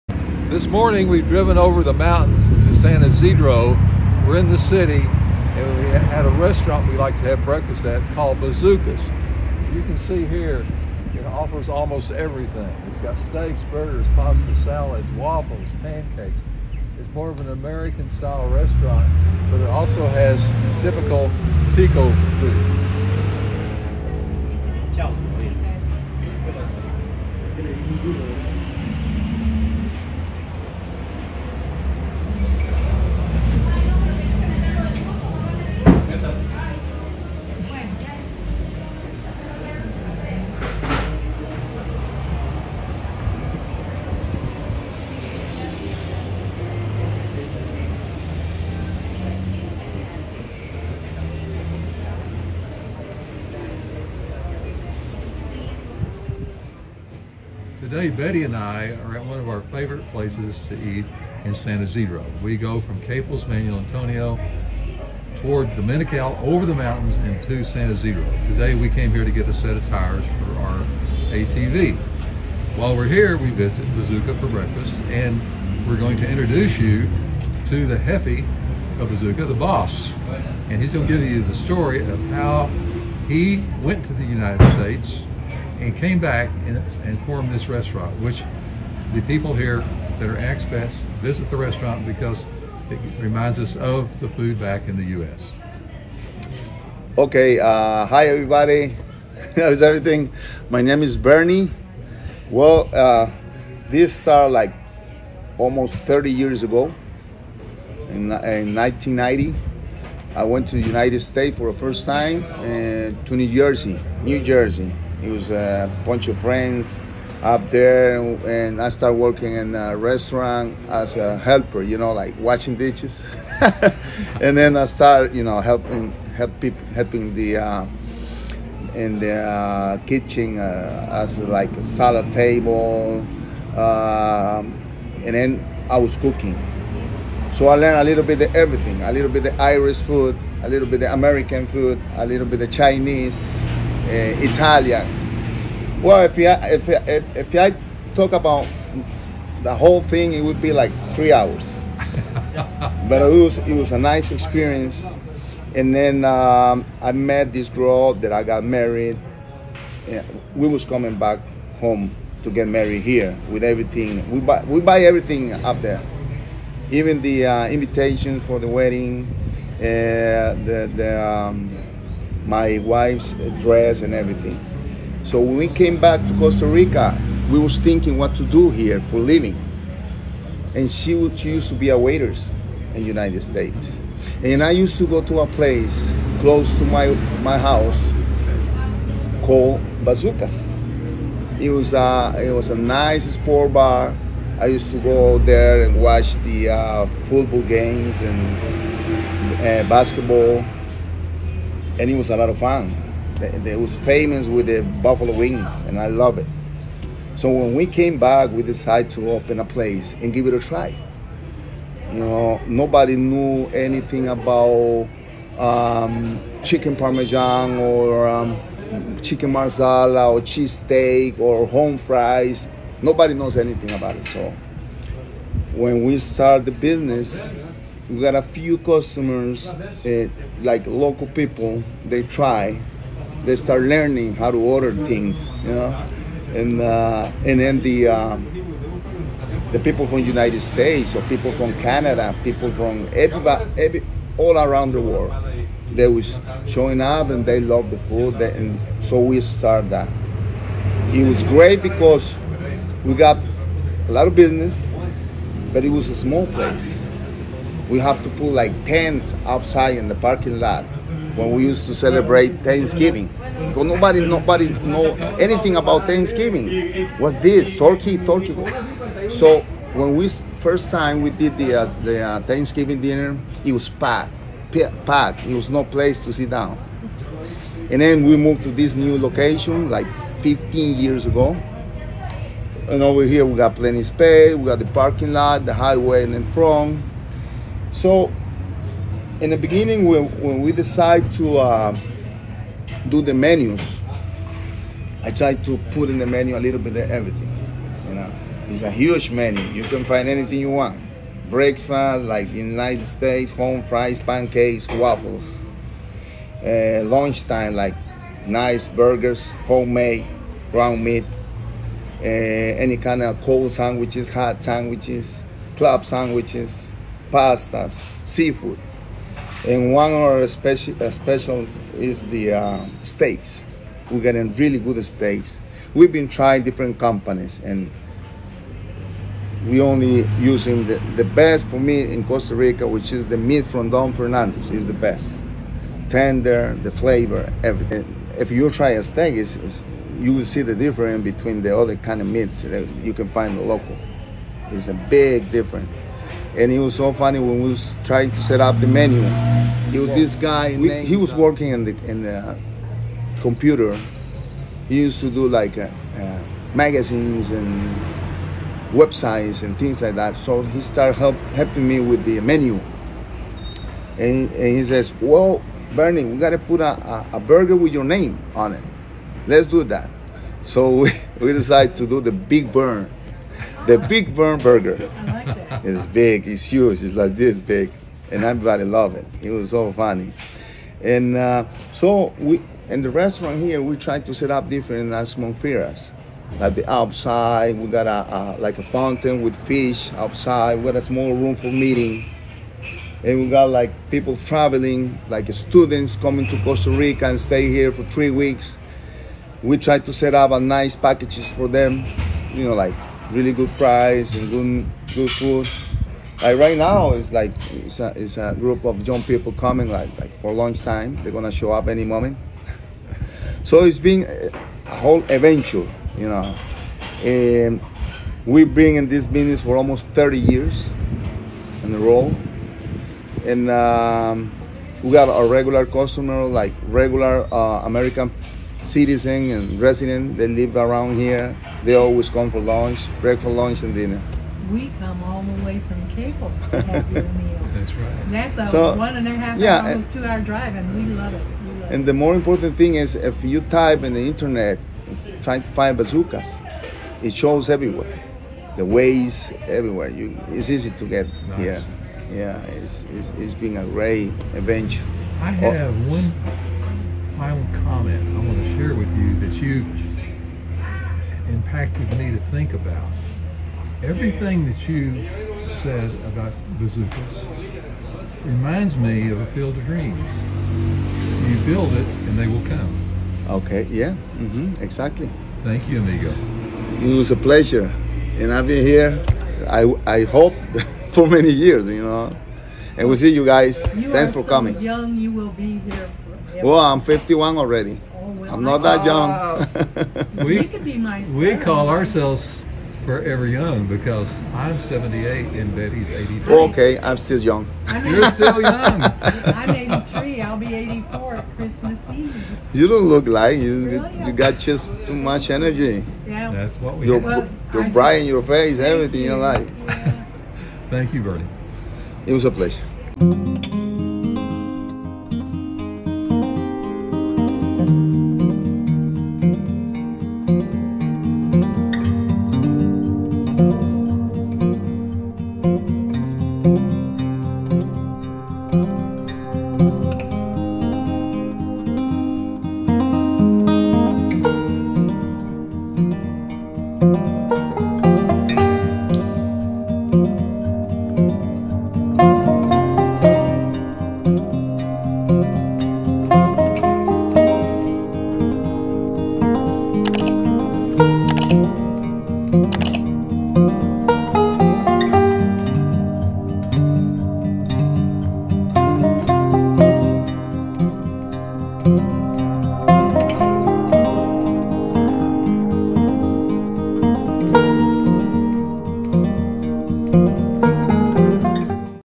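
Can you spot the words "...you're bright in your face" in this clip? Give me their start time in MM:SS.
08:27.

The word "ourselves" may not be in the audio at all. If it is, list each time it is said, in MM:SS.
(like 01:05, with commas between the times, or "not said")
08:11.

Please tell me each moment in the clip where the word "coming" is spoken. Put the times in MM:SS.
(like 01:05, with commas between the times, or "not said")
02:40, 06:36, 06:49, 08:04.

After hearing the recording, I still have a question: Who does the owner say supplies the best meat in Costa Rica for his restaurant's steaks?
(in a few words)
Don Fernandez.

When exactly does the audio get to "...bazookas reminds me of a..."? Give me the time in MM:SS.
07:46.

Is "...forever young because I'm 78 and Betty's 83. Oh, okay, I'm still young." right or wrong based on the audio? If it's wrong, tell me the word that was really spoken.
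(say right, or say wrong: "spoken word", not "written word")
right.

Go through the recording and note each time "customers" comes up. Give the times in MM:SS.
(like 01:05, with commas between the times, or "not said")
03:48, 07:05.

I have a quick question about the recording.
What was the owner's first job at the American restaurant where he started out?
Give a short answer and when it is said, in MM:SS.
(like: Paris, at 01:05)
washing dishes, at 02:02.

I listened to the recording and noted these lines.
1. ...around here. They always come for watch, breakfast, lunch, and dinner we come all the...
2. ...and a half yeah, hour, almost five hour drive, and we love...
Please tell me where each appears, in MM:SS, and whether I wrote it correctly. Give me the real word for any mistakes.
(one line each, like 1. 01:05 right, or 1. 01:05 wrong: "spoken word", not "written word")
1. 07:10 wrong: "lunch", not "watch"
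2. 07:19 wrong: "two", not "five".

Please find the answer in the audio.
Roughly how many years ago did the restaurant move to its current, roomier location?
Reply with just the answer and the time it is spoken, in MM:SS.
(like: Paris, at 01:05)
15, at 04:40.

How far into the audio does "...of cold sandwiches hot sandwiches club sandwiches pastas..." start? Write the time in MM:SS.
05:13.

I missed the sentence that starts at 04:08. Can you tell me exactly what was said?
They, and so we start that.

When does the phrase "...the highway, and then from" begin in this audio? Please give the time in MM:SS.
04:45.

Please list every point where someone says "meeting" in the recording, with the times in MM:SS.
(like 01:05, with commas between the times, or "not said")
06:31.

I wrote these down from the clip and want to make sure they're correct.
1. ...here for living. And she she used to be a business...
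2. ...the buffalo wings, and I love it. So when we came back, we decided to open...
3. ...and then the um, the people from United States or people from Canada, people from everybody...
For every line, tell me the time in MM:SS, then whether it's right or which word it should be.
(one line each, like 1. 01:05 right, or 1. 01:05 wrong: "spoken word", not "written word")
1. 02:58 wrong: "waitress", not "business"
2. 03:24 right
3. 03:57 right.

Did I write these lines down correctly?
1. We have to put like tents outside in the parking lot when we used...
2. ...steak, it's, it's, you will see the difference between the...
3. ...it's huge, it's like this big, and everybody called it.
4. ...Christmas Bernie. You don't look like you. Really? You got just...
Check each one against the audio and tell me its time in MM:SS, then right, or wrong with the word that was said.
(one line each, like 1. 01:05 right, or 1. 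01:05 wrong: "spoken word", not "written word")
1. 04:17 right
2. 05:39 right
3. 06:16 wrong: "loved", not "called"
4. 08:21 wrong: "Eve", not "Bernie".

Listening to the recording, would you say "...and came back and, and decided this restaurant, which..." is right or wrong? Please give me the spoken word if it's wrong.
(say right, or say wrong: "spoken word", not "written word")
wrong: "formed", not "decided".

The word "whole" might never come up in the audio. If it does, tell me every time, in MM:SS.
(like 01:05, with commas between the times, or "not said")
02:29, 06:54.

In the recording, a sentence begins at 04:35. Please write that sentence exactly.
It was no place to sit down.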